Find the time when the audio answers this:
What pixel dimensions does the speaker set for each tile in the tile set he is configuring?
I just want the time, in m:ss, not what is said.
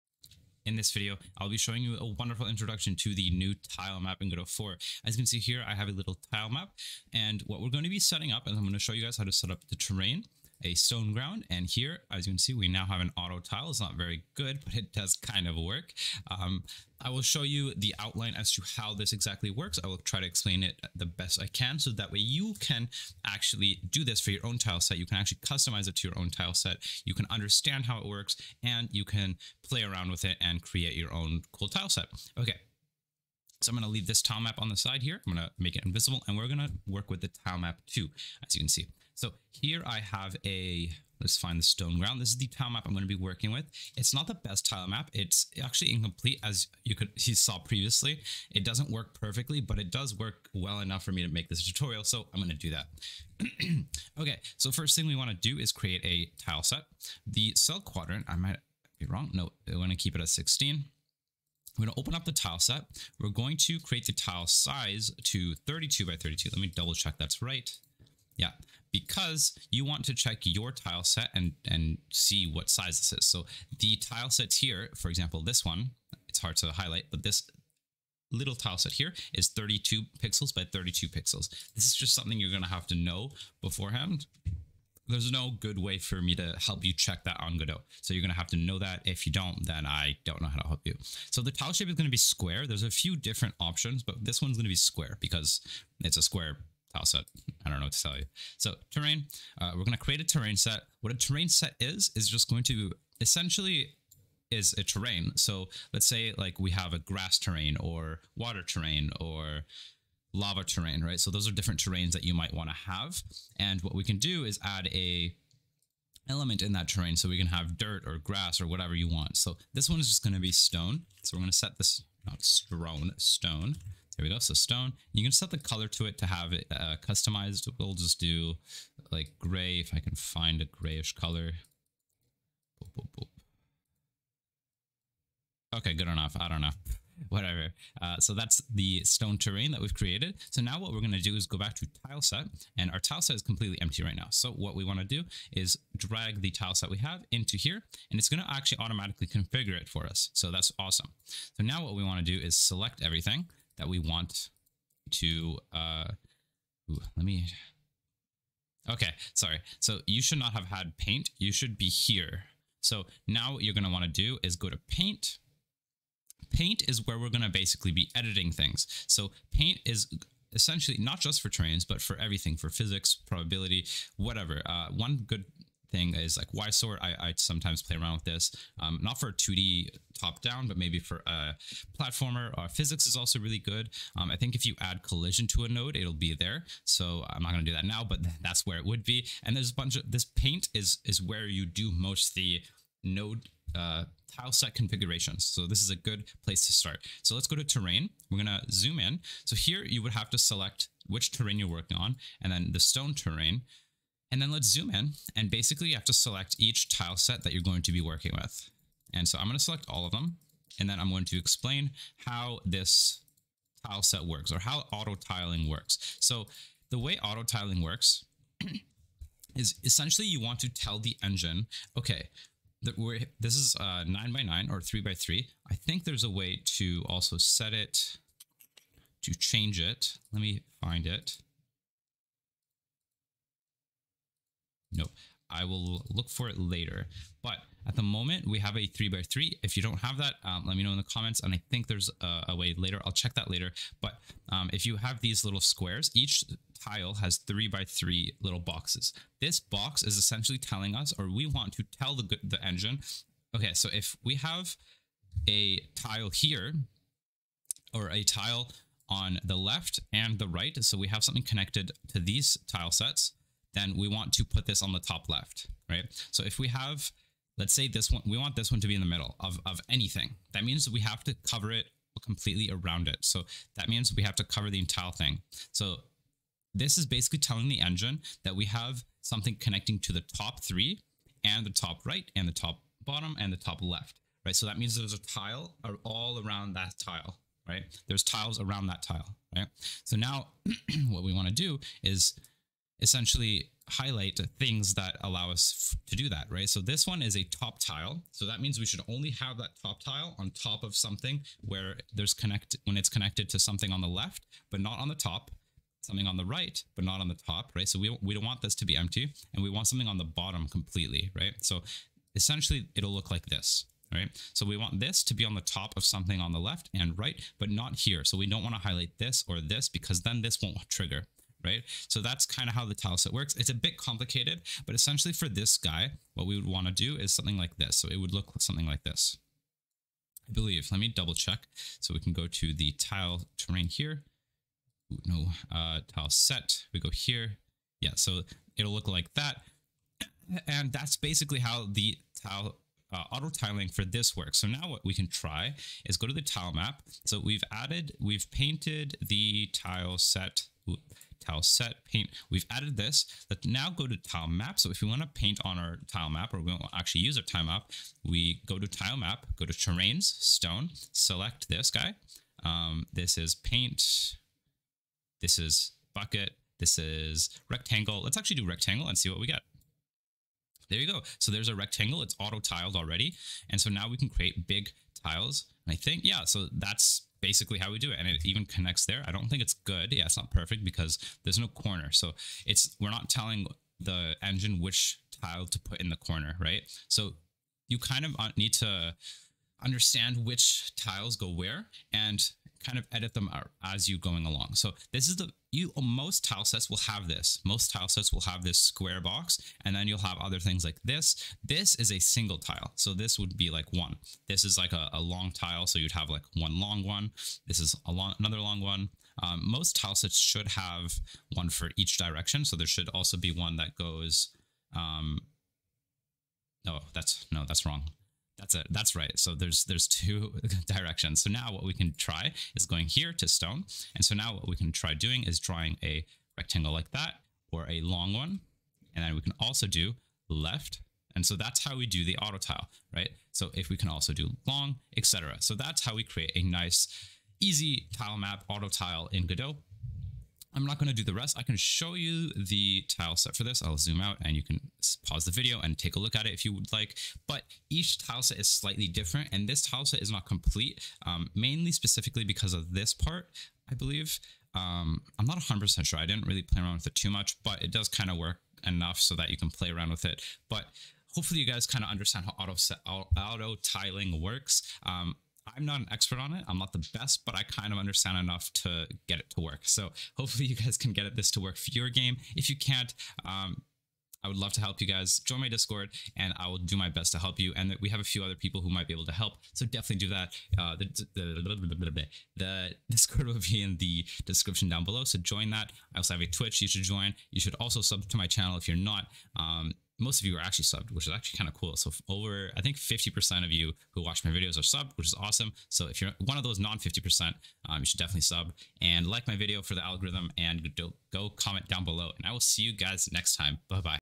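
1:05.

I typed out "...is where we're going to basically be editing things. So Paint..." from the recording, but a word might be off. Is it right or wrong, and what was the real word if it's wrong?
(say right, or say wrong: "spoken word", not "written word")
right.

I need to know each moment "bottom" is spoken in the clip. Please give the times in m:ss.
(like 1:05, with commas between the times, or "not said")
4:43, 5:10.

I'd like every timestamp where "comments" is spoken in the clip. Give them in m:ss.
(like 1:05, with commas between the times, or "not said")
4:01, 8:21.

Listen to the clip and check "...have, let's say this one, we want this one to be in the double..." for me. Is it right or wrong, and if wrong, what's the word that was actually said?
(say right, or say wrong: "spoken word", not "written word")
wrong: "middle", not "double".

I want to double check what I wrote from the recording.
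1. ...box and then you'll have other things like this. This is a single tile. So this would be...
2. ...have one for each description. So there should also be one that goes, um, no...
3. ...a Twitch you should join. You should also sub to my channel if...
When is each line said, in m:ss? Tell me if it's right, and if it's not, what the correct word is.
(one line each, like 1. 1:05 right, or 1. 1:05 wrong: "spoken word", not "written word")
1. 6:39 right
2. 6:50 wrong: "direction", not "description"
3. 8:06 right.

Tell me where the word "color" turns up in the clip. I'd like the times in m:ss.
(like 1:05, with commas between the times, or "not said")
2:05, 2:11.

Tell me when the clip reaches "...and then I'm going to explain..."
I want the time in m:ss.
3:30.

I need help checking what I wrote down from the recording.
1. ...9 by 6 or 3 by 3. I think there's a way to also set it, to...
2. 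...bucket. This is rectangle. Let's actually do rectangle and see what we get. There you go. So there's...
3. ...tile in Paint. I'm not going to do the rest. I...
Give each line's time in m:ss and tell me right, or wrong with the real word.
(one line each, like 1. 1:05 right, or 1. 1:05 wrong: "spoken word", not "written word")
1. 3:44 wrong: "9", not "6"
2. 6:06 right
3. 7:18 wrong: "Godot", not "Paint".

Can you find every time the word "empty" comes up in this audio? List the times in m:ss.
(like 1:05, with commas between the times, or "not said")
2:23, 5:08.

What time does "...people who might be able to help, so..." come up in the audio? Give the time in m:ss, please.
7:58.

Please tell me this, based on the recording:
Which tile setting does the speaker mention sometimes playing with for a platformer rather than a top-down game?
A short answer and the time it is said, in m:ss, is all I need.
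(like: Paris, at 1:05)
Y sort, at 2:56.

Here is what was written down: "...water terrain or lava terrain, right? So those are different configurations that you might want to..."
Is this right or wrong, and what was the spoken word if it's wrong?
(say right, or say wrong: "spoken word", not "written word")
wrong: "terrains", not "configurations".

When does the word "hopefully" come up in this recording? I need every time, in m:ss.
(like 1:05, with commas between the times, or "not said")
7:41, 7:50.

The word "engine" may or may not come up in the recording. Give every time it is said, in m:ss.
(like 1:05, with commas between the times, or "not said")
3:41, 4:12, 4:37, 6:24.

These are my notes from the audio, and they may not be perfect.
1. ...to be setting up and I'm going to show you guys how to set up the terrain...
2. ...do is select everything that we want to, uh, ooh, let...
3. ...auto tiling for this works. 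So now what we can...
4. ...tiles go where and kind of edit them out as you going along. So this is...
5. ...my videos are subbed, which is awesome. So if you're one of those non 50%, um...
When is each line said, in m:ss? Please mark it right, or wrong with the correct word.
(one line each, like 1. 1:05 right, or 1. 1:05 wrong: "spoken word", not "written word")
1. 0:07 right
2. 2:32 right
3. 5:43 right
4. 6:30 right
5. 8:14 right.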